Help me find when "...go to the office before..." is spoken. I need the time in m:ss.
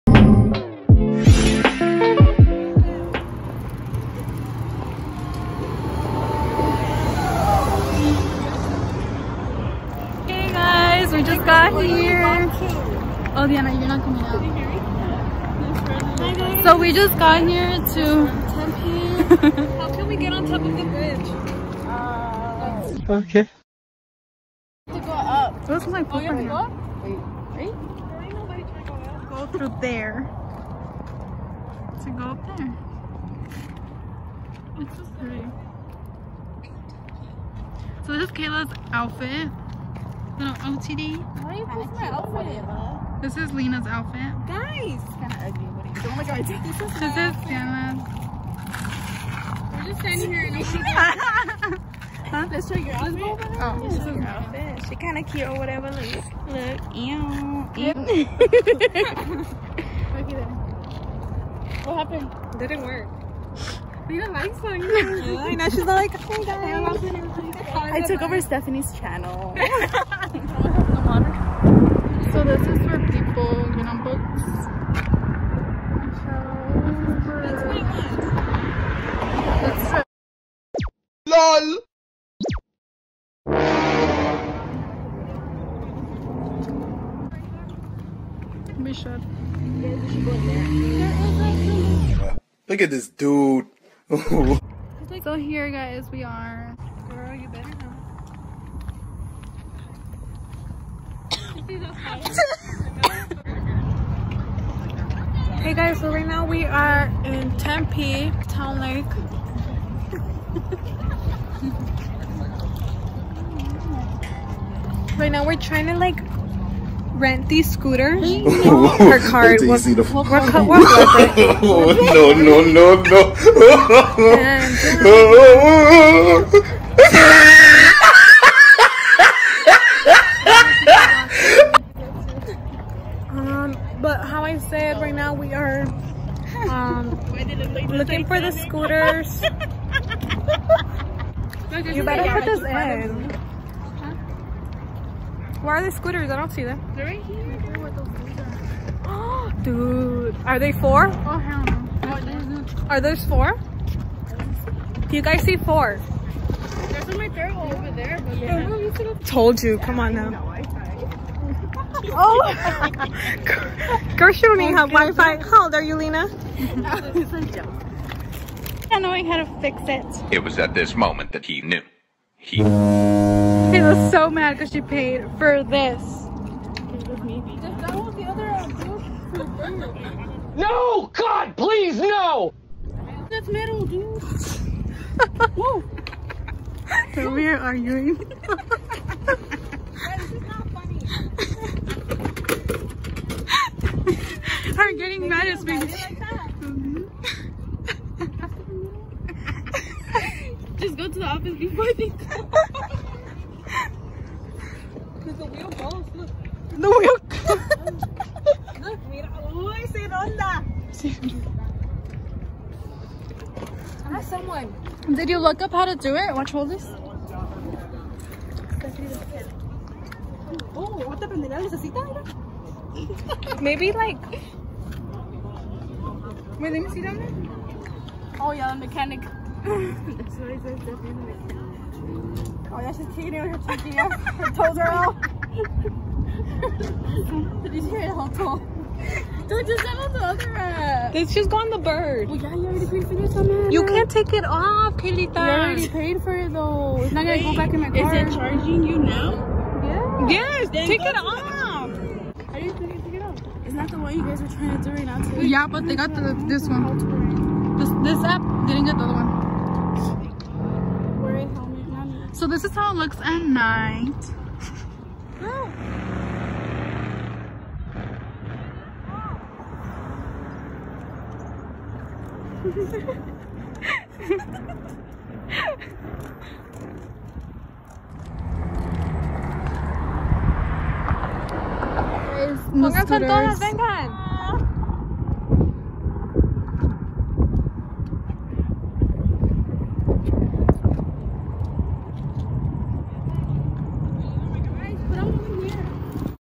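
3:20.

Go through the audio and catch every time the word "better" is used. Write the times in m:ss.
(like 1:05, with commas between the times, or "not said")
1:37, 2:22.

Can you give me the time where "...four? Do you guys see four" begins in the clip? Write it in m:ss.
2:33.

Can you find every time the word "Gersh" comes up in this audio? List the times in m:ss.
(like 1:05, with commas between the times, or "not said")
2:44.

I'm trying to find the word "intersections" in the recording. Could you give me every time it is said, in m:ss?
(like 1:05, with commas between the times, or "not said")
not said.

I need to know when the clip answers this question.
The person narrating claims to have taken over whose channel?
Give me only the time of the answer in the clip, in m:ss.
1:08.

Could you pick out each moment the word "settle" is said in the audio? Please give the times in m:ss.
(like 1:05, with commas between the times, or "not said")
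3:59.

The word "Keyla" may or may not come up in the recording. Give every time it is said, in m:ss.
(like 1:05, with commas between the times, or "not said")
0:38.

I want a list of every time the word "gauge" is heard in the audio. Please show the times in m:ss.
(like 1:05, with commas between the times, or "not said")
not said.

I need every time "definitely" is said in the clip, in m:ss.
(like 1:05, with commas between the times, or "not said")
3:50.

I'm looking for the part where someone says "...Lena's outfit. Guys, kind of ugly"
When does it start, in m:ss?
0:43.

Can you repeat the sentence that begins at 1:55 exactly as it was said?
right now we're trying to like rent these scooters.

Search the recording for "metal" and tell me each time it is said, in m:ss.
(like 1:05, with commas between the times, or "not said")
3:03.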